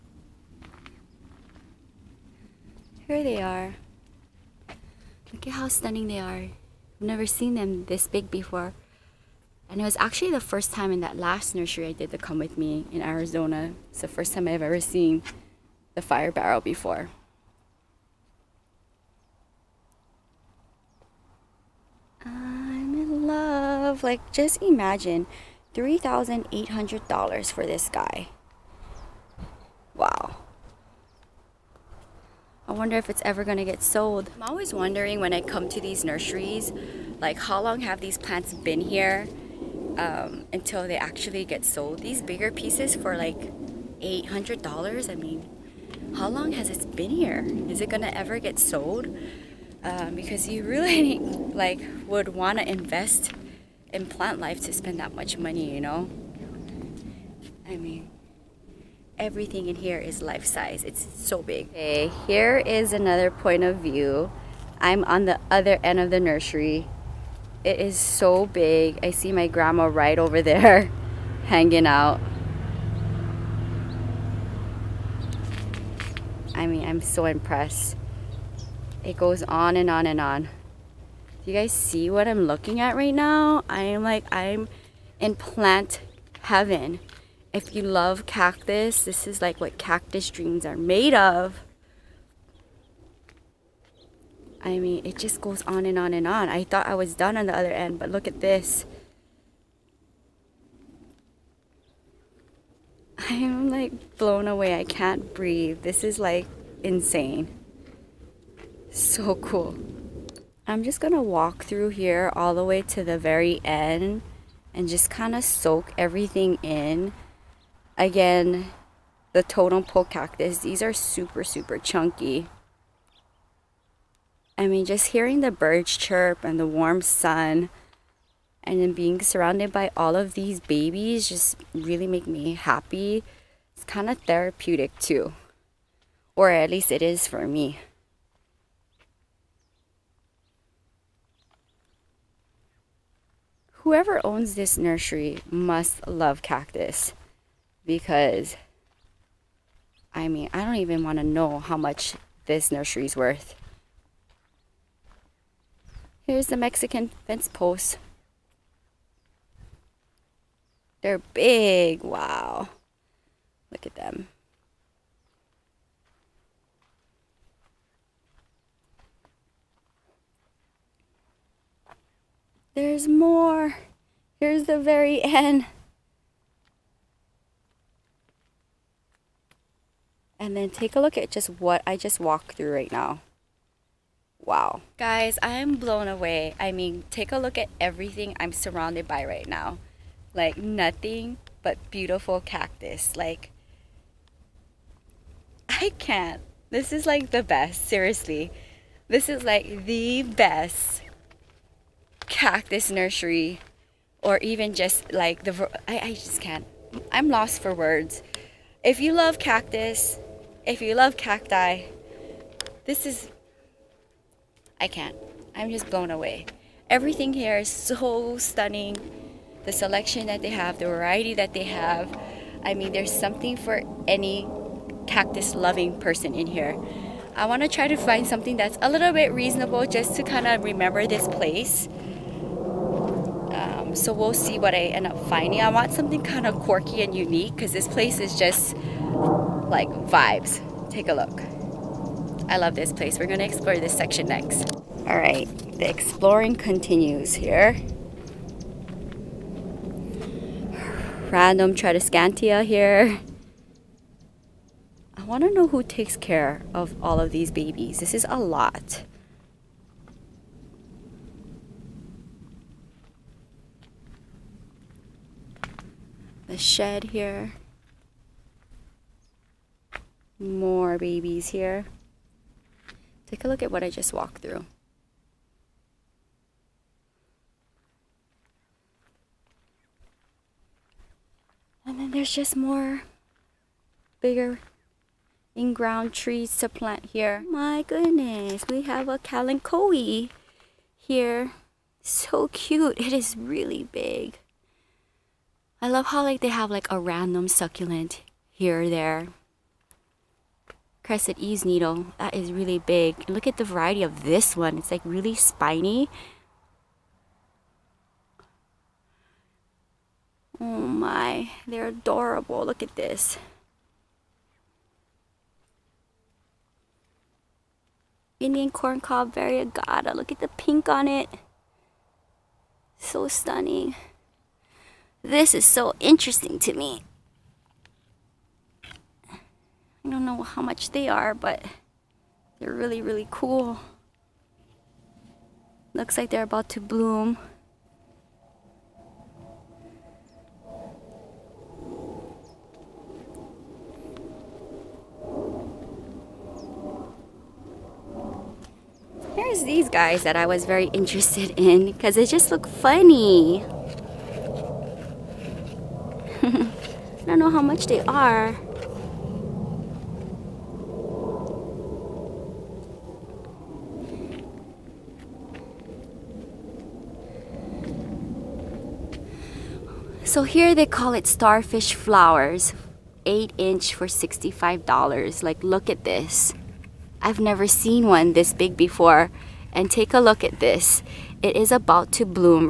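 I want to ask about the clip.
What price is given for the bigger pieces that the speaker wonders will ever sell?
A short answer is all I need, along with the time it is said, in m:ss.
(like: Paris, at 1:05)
$800, at 0:43.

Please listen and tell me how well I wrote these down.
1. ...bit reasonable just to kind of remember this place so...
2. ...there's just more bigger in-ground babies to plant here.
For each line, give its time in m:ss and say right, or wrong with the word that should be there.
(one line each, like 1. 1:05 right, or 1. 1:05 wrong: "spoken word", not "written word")
1. 3:49 right
2. 4:42 wrong: "trees", not "babies".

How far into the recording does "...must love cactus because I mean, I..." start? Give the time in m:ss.
2:25.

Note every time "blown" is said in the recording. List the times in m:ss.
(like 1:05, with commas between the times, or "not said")
1:44, 3:05, 3:35.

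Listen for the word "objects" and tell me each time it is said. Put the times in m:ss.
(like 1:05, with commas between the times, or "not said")
not said.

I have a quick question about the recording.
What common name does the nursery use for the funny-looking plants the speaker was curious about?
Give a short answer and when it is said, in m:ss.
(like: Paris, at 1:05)
starfish flowers, at 6:11.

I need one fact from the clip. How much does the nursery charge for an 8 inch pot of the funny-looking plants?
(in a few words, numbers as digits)
$65.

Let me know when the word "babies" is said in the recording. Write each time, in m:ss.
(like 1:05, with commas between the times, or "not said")
2:10, 4:17, 4:30.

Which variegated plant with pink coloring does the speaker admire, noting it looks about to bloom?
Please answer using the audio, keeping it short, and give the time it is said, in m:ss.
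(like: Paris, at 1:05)
Indian corn cob variegata, at 5:18.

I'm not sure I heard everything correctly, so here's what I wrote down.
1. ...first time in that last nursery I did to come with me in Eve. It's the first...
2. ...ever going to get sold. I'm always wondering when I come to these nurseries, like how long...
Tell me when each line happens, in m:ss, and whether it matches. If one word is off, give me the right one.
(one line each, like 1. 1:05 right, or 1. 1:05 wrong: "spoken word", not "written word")
1. 0:10 wrong: "Arizona", not "Eve"
2. 0:33 right.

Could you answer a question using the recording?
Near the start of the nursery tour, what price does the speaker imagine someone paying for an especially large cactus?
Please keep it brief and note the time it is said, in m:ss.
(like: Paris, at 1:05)
$3,800, at 0:25.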